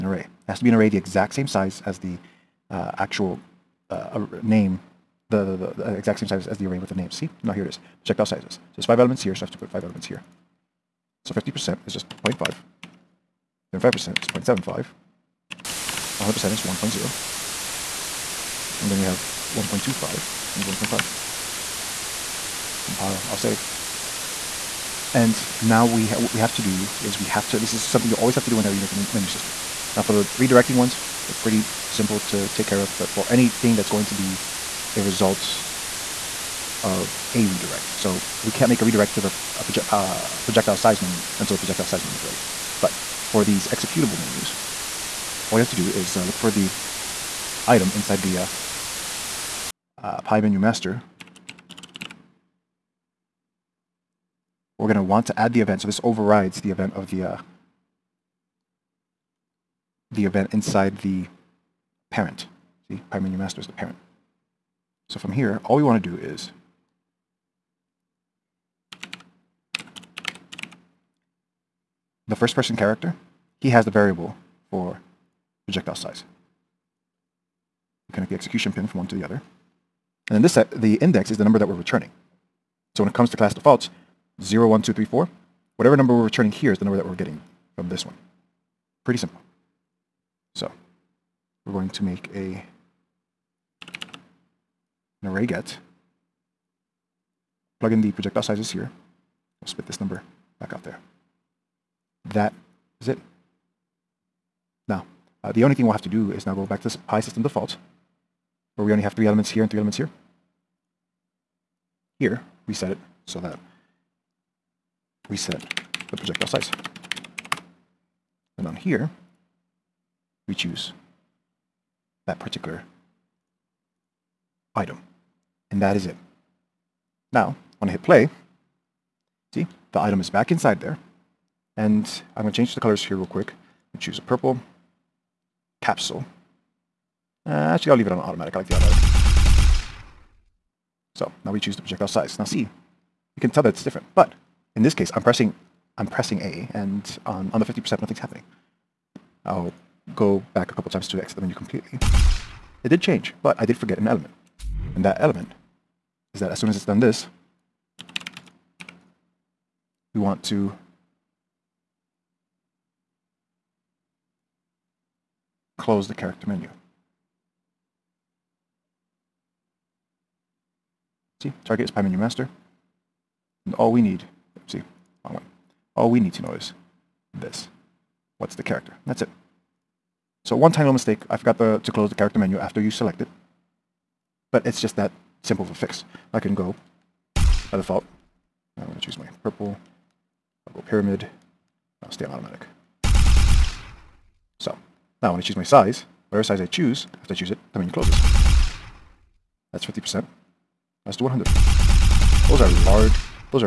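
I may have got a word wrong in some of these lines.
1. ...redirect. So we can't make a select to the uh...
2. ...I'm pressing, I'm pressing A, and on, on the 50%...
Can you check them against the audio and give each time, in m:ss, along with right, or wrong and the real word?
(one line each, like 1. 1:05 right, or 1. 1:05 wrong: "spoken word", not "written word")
1. 0:37 wrong: "redirect", not "select"
2. 2:25 right.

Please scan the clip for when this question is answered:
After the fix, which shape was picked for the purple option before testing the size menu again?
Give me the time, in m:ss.
3:10.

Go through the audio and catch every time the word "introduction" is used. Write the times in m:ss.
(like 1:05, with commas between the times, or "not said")
not said.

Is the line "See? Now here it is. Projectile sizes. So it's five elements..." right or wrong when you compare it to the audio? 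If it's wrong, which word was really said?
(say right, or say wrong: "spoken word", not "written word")
right.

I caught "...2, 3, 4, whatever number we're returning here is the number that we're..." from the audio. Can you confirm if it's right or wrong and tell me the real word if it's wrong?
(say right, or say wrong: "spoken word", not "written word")
right.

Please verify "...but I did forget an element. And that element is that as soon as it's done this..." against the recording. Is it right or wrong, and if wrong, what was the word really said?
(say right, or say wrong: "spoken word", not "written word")
right.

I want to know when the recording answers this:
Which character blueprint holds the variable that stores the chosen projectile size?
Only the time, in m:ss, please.
1:12.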